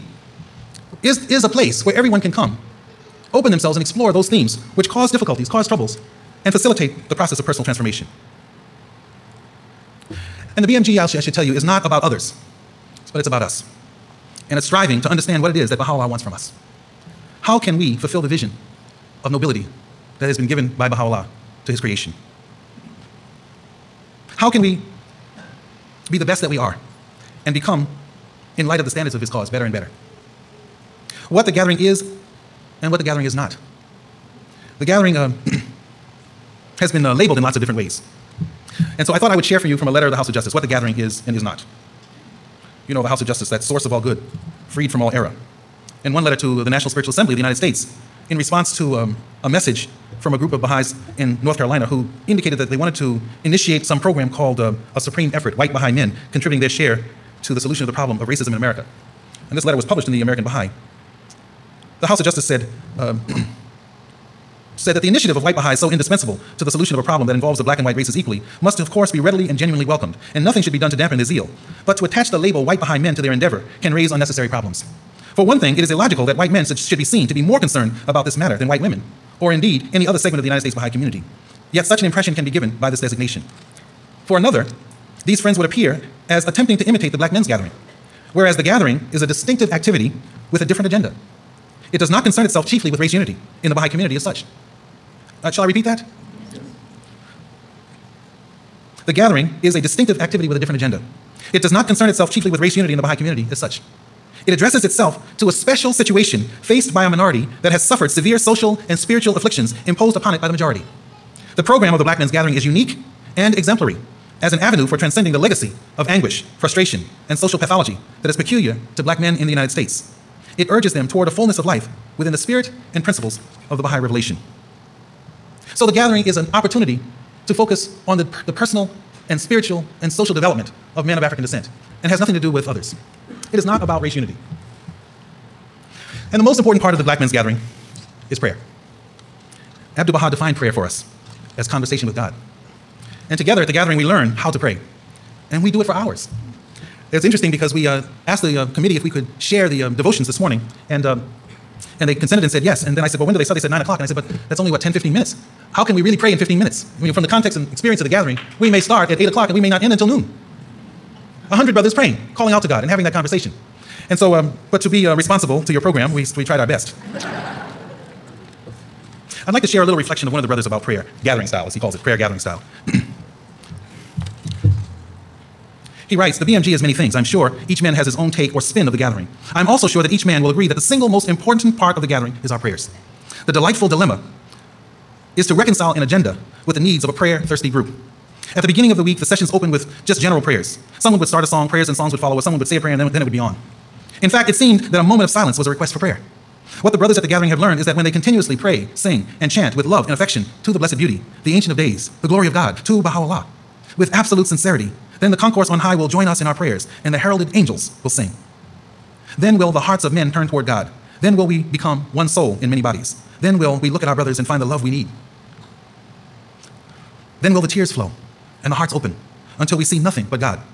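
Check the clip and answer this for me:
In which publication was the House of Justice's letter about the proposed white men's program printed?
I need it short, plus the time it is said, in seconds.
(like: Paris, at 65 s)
The American Baha'i, at 60 s.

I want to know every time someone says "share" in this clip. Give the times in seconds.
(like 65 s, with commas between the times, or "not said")
39 s, 56 s, 149 s, 169 s.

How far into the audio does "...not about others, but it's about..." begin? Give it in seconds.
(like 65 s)
11 s.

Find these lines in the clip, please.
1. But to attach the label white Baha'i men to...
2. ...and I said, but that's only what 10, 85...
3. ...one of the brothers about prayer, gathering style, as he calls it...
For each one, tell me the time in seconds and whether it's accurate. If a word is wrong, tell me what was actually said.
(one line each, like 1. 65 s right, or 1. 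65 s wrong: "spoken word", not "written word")
1. 71 s right
2. 153 s wrong: "15", not "85"
3. 170 s right.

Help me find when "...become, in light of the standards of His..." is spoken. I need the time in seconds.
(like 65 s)
27 s.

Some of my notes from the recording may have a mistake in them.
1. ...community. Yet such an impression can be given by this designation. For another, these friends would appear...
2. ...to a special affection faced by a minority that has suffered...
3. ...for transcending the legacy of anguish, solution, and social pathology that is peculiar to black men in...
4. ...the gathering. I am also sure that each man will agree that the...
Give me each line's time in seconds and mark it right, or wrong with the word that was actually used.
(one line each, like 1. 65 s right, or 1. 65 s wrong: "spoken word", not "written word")
1. 80 s right
2. 105 s wrong: "situation", not "affection"
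3. 114 s wrong: "frustration", not "solution"
4. 178 s right.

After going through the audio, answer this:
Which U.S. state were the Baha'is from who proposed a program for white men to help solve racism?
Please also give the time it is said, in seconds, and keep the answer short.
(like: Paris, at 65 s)
North Carolina, at 51 s.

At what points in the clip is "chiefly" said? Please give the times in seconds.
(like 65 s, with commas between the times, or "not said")
92 s, 102 s.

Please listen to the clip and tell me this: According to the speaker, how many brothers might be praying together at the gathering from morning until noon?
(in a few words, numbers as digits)
100.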